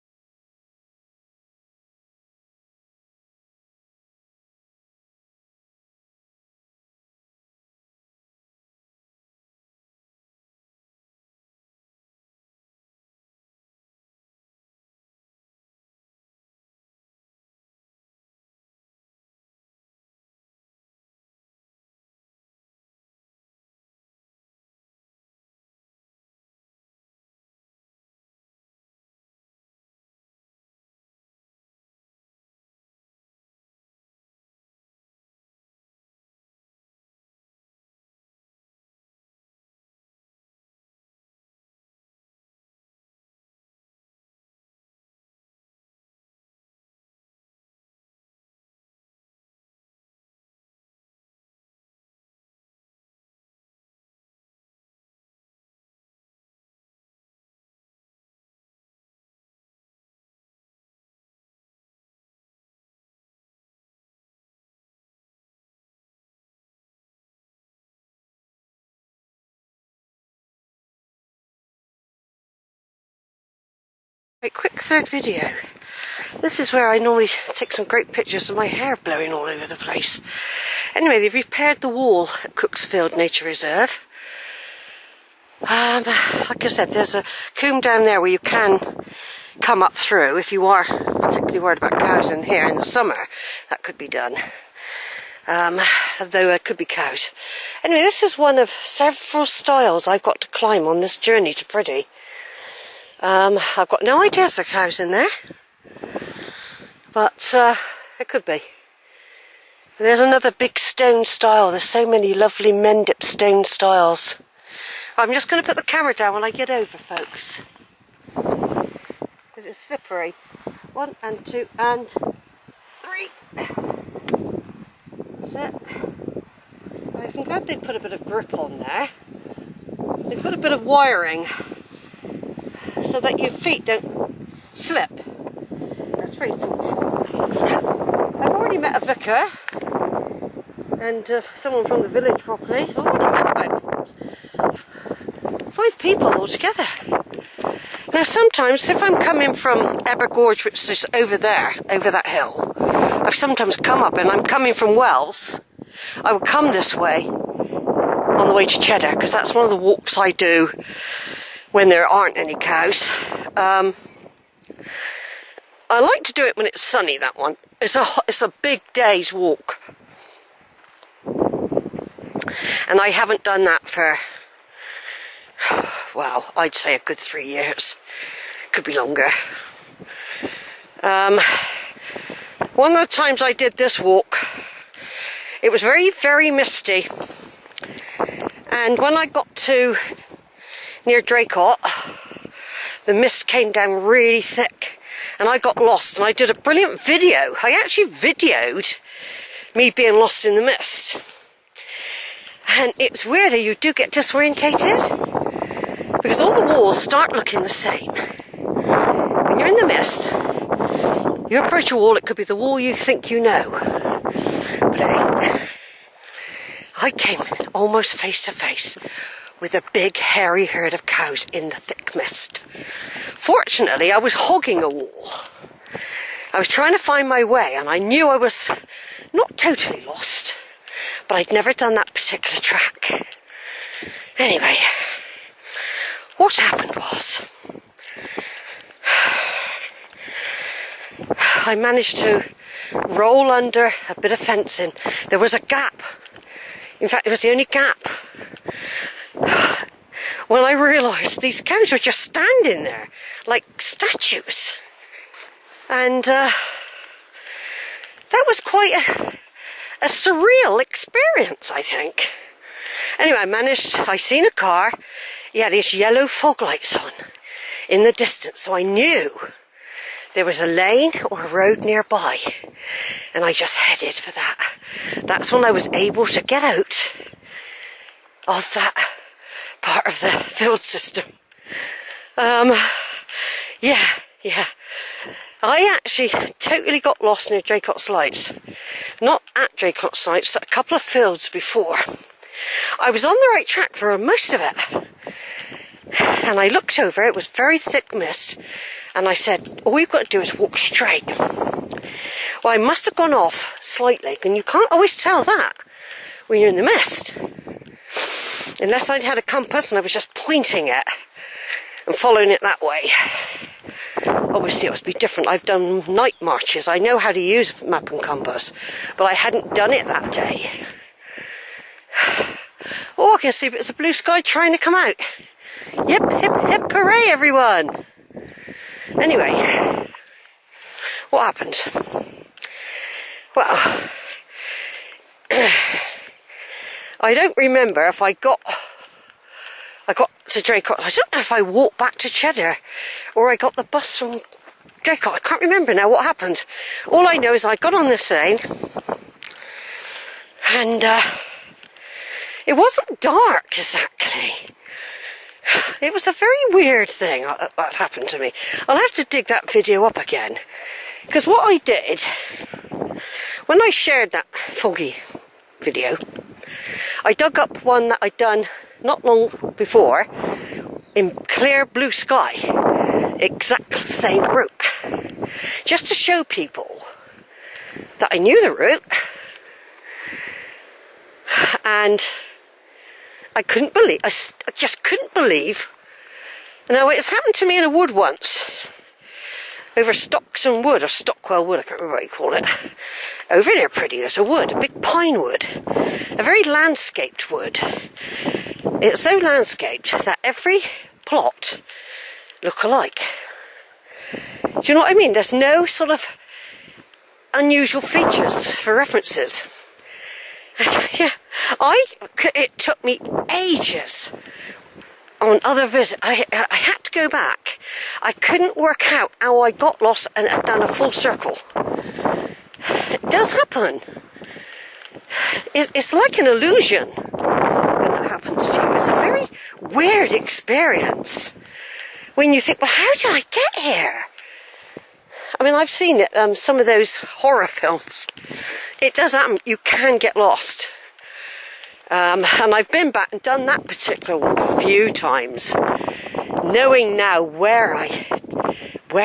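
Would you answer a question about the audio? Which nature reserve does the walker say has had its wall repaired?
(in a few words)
Cooksfield Nature Reserve.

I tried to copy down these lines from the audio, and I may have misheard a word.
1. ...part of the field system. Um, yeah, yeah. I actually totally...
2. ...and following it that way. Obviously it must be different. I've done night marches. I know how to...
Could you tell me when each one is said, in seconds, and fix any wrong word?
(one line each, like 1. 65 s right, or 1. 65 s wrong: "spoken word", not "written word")
1. 279 s right
2. 312 s right.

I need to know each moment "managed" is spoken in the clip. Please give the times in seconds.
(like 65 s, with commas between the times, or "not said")
241 s, 263 s.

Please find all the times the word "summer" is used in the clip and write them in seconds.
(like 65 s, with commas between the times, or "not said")
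92 s.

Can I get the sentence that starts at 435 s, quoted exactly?
I mean, I've seen um, some of those horror films.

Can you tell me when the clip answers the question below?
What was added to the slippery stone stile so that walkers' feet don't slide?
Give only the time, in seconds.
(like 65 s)
130 s.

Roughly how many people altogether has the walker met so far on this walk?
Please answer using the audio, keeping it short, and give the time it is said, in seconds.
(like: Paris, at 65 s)
5, at 145 s.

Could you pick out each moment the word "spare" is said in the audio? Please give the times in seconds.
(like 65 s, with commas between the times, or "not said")
not said.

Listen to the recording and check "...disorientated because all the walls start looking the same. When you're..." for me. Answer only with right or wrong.
right.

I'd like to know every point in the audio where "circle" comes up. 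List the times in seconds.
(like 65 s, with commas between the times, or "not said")
421 s.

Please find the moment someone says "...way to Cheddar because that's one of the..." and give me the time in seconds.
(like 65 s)
158 s.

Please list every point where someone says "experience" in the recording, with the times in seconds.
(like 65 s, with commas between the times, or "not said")
260 s, 430 s.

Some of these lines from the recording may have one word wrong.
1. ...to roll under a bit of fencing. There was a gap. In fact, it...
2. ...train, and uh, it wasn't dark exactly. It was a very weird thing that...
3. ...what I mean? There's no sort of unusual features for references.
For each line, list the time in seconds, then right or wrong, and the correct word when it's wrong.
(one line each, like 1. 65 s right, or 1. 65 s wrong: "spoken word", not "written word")
1. 242 s right
2. 348 s right
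3. 405 s right.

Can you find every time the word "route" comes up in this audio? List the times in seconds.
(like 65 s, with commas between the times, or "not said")
374 s, 378 s.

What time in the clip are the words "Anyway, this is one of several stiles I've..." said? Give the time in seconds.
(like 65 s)
97 s.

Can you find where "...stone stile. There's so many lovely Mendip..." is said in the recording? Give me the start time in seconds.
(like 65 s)
110 s.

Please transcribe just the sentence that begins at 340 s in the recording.
I don't know if I walked back to Cheddar or I got the bus from Draycott.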